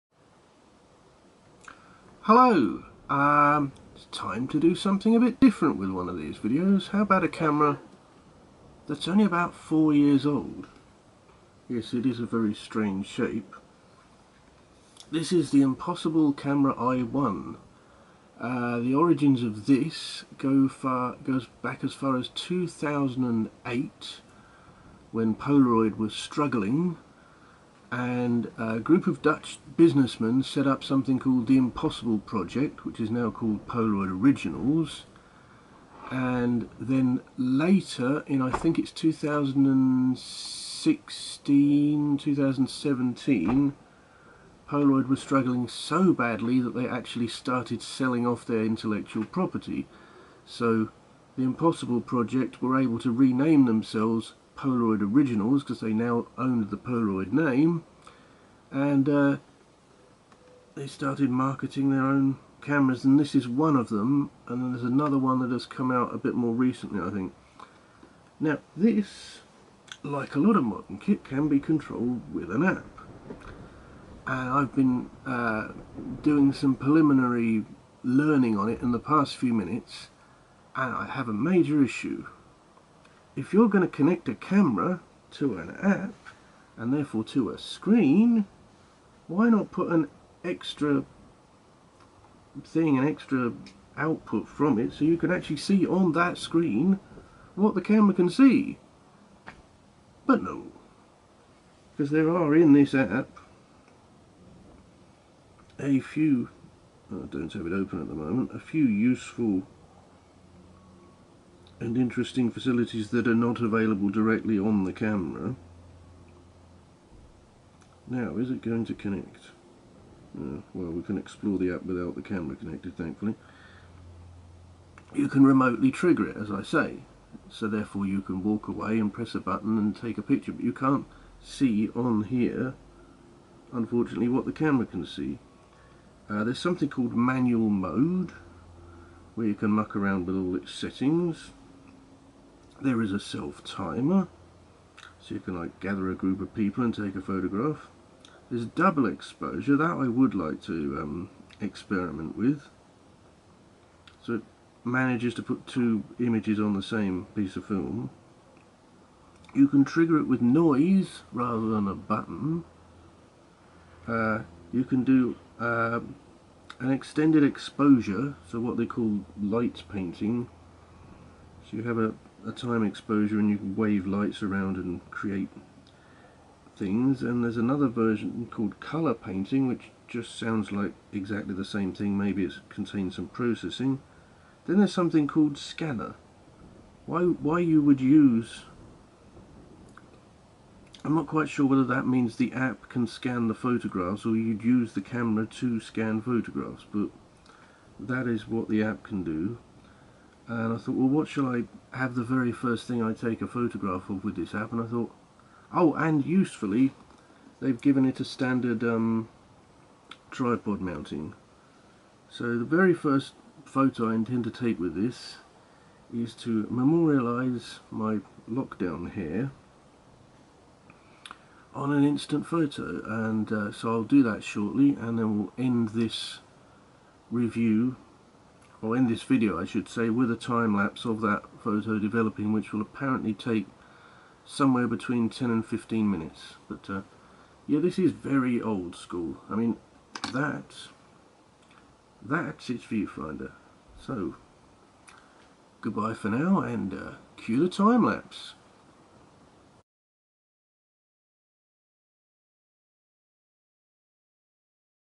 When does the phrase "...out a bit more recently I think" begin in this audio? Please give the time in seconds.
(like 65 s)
65 s.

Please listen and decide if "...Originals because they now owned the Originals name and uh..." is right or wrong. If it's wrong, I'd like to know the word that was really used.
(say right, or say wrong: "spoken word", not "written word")
wrong: "Polaroid", not "Originals".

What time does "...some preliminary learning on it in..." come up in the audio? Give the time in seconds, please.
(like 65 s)
76 s.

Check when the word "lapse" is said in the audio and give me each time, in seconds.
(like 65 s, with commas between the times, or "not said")
230 s, 248 s.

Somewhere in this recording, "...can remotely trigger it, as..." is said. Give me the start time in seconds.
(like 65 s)
125 s.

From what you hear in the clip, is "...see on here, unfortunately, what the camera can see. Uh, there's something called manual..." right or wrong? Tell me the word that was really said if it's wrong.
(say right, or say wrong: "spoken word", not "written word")
right.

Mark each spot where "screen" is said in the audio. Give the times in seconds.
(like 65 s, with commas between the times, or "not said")
87 s, 96 s.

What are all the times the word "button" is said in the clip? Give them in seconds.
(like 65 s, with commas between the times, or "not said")
129 s, 161 s.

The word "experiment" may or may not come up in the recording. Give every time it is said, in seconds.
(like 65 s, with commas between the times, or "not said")
151 s.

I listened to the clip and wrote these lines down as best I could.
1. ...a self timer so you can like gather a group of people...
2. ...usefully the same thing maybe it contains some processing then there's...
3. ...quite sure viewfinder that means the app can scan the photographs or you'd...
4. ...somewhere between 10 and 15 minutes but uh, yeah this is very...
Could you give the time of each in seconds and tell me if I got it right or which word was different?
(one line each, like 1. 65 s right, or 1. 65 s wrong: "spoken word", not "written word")
1. 143 s right
2. 181 s wrong: "exactly", not "usefully"
3. 191 s wrong: "whether", not "viewfinder"
4. 234 s right.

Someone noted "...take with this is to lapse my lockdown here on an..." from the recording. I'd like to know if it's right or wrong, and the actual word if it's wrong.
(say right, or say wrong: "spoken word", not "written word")
wrong: "memorialise", not "lapse".